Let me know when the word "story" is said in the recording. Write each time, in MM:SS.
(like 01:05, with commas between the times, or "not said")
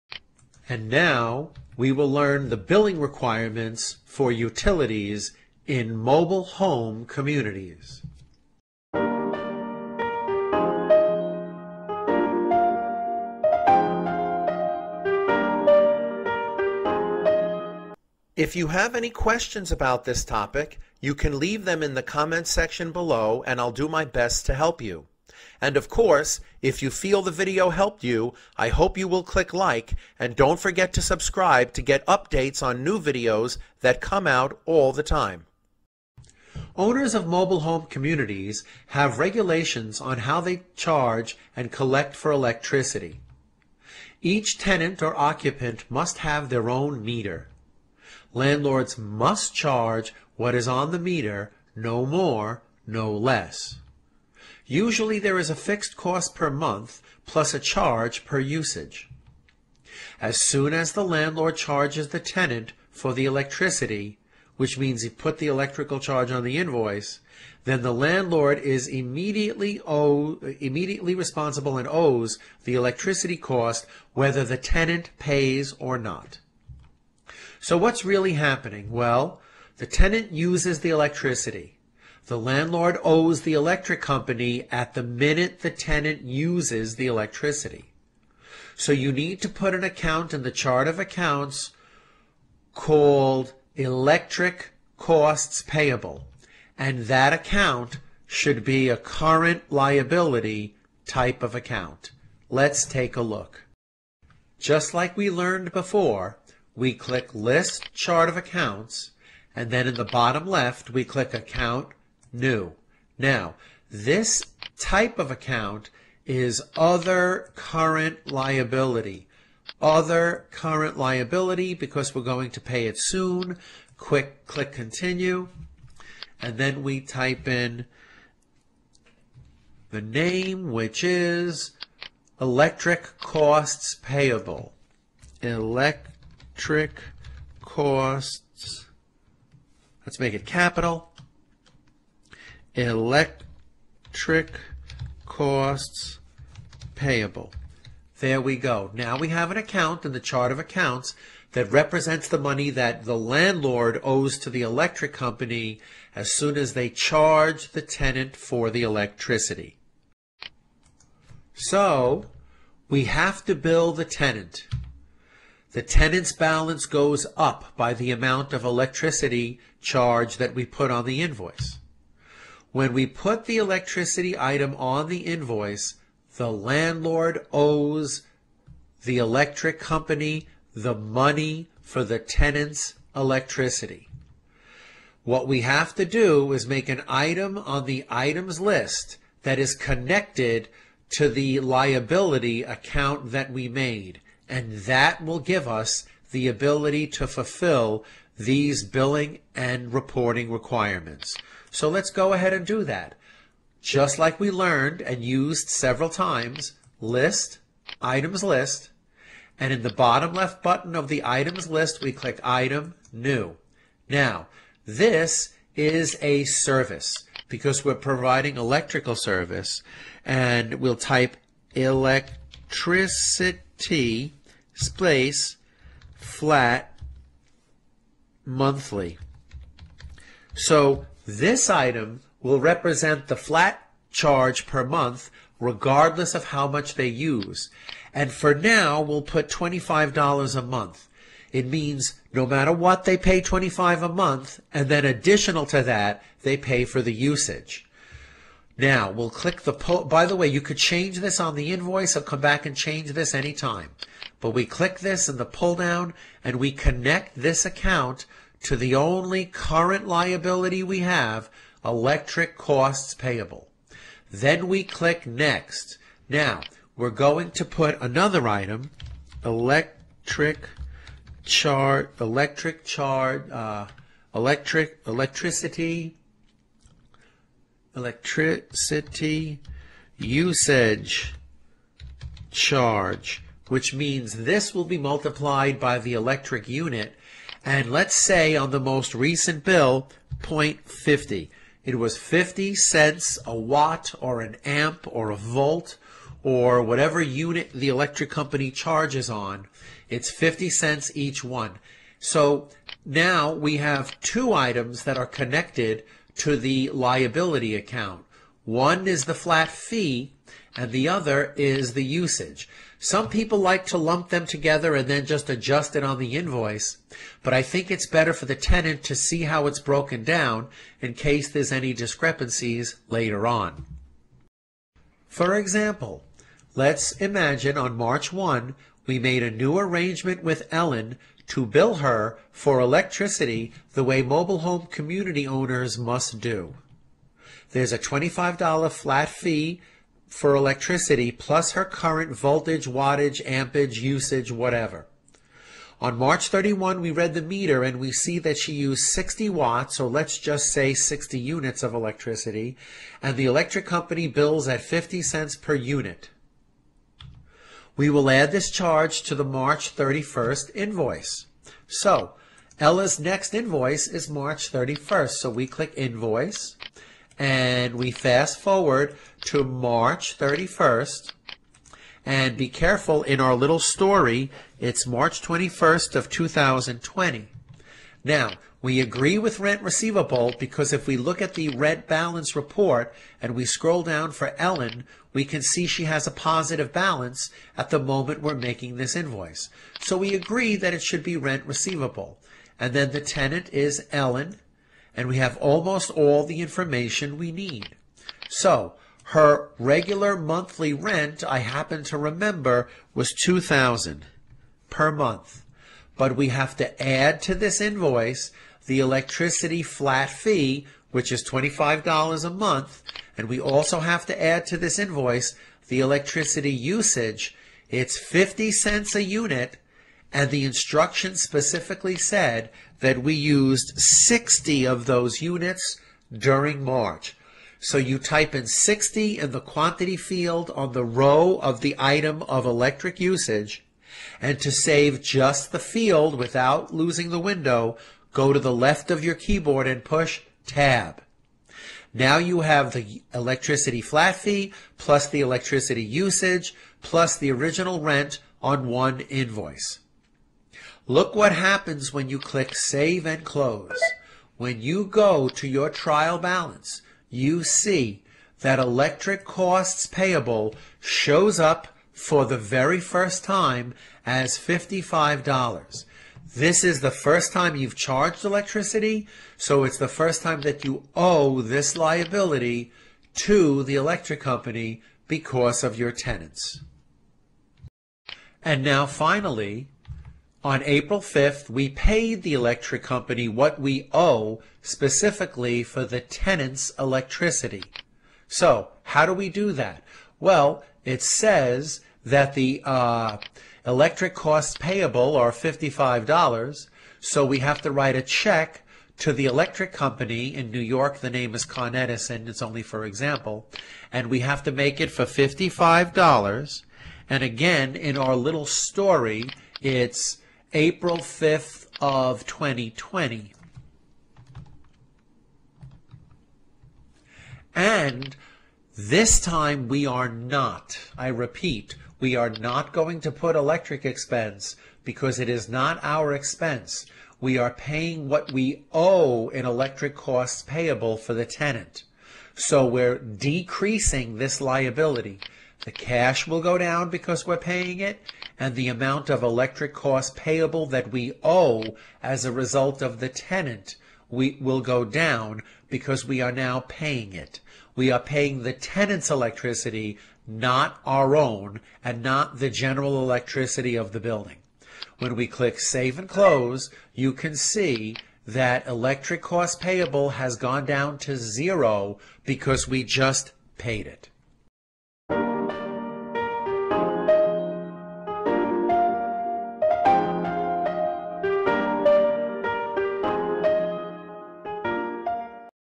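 06:13, 08:28.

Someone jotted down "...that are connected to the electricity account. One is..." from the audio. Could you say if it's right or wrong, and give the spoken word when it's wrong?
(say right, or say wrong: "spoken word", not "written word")
wrong: "liability", not "electricity".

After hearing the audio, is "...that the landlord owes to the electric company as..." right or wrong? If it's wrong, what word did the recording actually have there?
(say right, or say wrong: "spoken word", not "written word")
right.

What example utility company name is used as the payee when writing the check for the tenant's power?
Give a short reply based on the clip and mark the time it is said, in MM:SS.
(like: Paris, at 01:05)
Con Edison, at 08:21.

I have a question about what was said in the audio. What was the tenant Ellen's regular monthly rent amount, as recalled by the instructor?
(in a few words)
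2000.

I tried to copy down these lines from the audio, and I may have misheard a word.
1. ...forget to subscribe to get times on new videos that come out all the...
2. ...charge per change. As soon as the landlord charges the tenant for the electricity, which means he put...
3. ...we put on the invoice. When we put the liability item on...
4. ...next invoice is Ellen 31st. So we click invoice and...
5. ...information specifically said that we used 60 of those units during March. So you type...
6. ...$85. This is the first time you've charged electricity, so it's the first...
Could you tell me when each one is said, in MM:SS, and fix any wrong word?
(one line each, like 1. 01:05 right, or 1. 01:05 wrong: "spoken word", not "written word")
1. 00:30 wrong: "updates", not "times"
2. 00:57 wrong: "usage", not "change"
3. 02:50 wrong: "electricity", not "liability"
4. 06:03 wrong: "March", not "Ellen"
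5. 07:00 wrong: "instruction", not "information"
6. 07:44 wrong: "55", not "85".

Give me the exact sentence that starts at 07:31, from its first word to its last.
Look what happens when you click Save and Close.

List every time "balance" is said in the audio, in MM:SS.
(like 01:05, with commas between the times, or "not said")
02:46, 06:22, 06:26, 07:36.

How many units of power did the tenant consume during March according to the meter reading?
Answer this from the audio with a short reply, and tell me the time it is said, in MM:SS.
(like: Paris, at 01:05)
60, at 05:50.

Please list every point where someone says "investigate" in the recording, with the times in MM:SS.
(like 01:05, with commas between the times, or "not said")
not said.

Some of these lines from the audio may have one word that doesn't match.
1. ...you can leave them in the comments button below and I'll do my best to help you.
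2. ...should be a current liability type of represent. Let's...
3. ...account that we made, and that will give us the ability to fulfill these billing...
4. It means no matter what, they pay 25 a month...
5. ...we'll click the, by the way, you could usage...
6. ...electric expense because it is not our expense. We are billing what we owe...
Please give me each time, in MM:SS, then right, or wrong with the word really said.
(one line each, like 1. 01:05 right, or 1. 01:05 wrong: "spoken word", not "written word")
1. 00:21 wrong: "section", not "button"
2. 01:38 wrong: "account", not "represent"
3. 03:12 right
4. 04:01 right
5. 04:09 wrong: "change", not "usage"
6. 08:43 wrong: "paying", not "billing".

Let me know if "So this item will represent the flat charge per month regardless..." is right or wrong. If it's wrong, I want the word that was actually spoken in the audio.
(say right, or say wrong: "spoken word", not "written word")
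right.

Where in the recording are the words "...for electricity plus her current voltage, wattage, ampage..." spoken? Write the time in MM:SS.
05:40.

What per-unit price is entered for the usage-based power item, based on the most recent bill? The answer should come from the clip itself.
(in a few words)
0.50.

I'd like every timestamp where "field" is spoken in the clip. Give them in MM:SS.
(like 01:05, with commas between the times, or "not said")
07:10, 07:15.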